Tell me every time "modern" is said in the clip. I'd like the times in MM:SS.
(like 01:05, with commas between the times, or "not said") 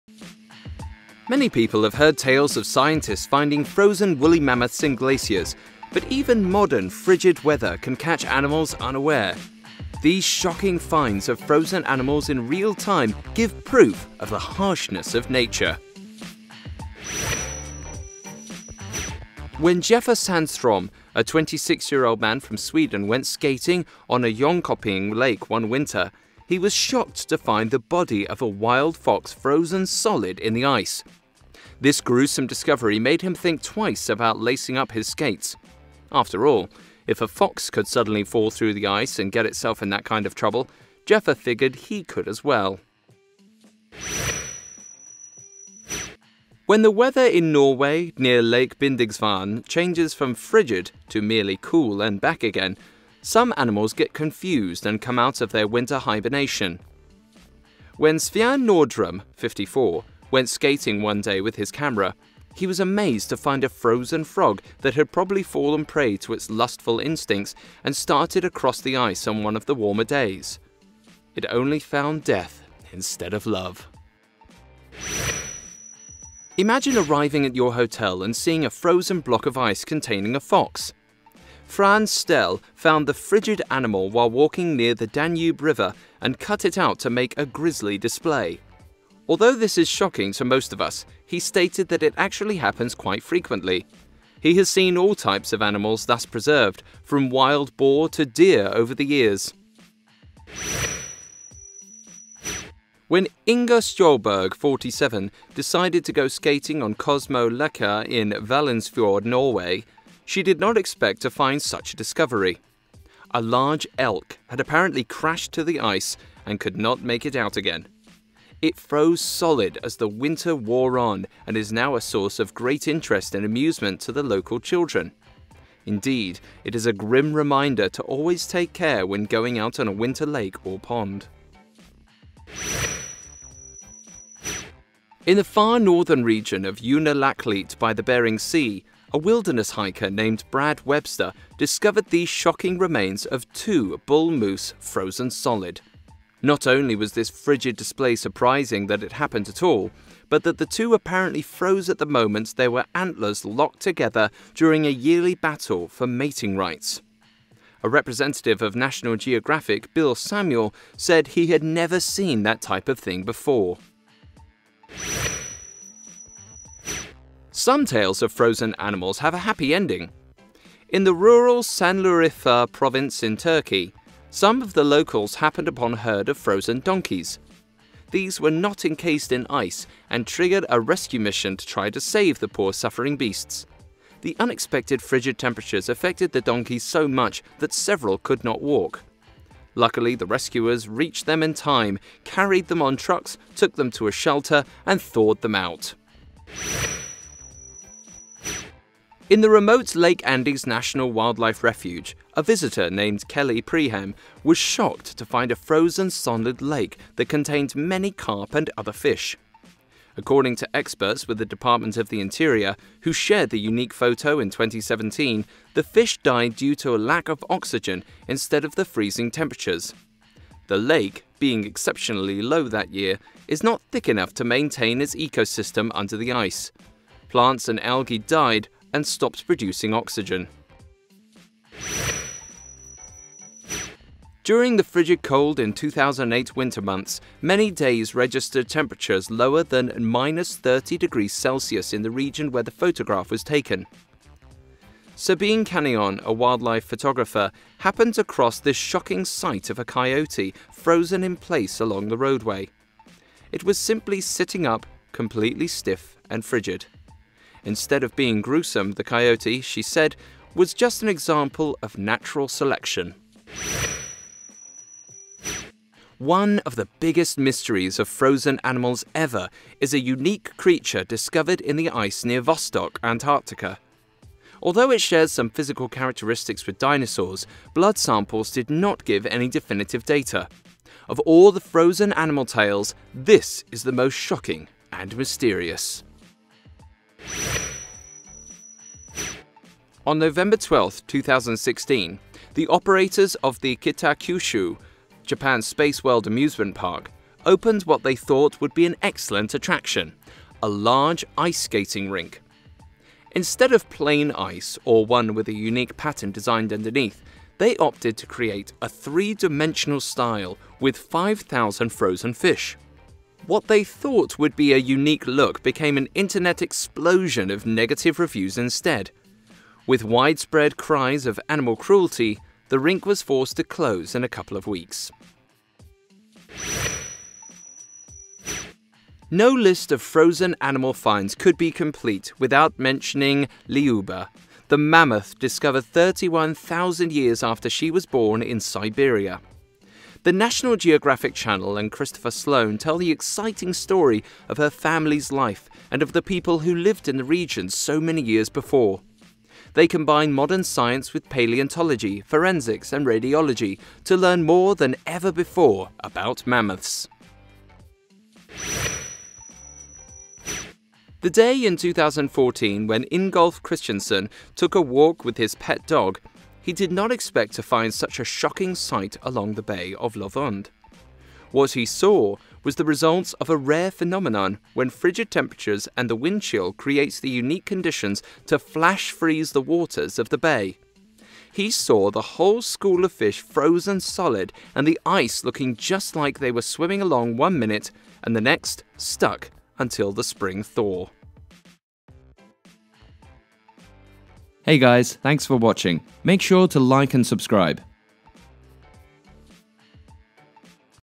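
00:06, 05:50.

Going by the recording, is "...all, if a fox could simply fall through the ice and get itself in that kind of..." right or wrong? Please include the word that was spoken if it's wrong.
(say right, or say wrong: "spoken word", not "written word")
wrong: "suddenly", not "simply".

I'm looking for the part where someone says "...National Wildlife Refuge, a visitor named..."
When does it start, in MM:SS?
03:20.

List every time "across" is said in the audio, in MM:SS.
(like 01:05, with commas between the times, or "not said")
01:08, 04:08.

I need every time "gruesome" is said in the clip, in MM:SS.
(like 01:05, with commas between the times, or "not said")
00:32, 04:18.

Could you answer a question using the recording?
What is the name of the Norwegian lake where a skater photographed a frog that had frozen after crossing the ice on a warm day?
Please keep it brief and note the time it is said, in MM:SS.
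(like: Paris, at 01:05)
Lake Bindigsvann, at 00:48.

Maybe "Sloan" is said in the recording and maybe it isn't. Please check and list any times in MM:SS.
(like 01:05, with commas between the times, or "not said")
05:42.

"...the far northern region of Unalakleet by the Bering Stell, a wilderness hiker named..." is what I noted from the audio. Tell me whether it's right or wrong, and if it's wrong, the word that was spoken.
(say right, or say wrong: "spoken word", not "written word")
wrong: "Sea", not "Stell".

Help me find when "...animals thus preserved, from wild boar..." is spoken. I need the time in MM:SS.
01:35.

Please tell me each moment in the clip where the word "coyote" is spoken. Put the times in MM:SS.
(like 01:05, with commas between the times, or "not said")
04:09, 04:19.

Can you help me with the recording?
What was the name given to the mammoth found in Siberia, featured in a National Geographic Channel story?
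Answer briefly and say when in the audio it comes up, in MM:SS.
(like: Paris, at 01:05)
Lyuba, at 05:33.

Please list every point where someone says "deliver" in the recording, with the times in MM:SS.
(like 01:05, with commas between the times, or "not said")
not said.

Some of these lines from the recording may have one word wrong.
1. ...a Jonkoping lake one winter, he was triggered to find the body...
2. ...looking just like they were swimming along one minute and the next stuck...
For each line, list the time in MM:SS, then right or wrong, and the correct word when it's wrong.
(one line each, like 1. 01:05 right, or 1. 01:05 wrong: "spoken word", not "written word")
1. 00:24 wrong: "shocked", not "triggered"
2. 06:25 right.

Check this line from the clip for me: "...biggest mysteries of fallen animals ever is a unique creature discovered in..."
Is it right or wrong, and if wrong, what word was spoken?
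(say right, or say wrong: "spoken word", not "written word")
wrong: "frozen", not "fallen".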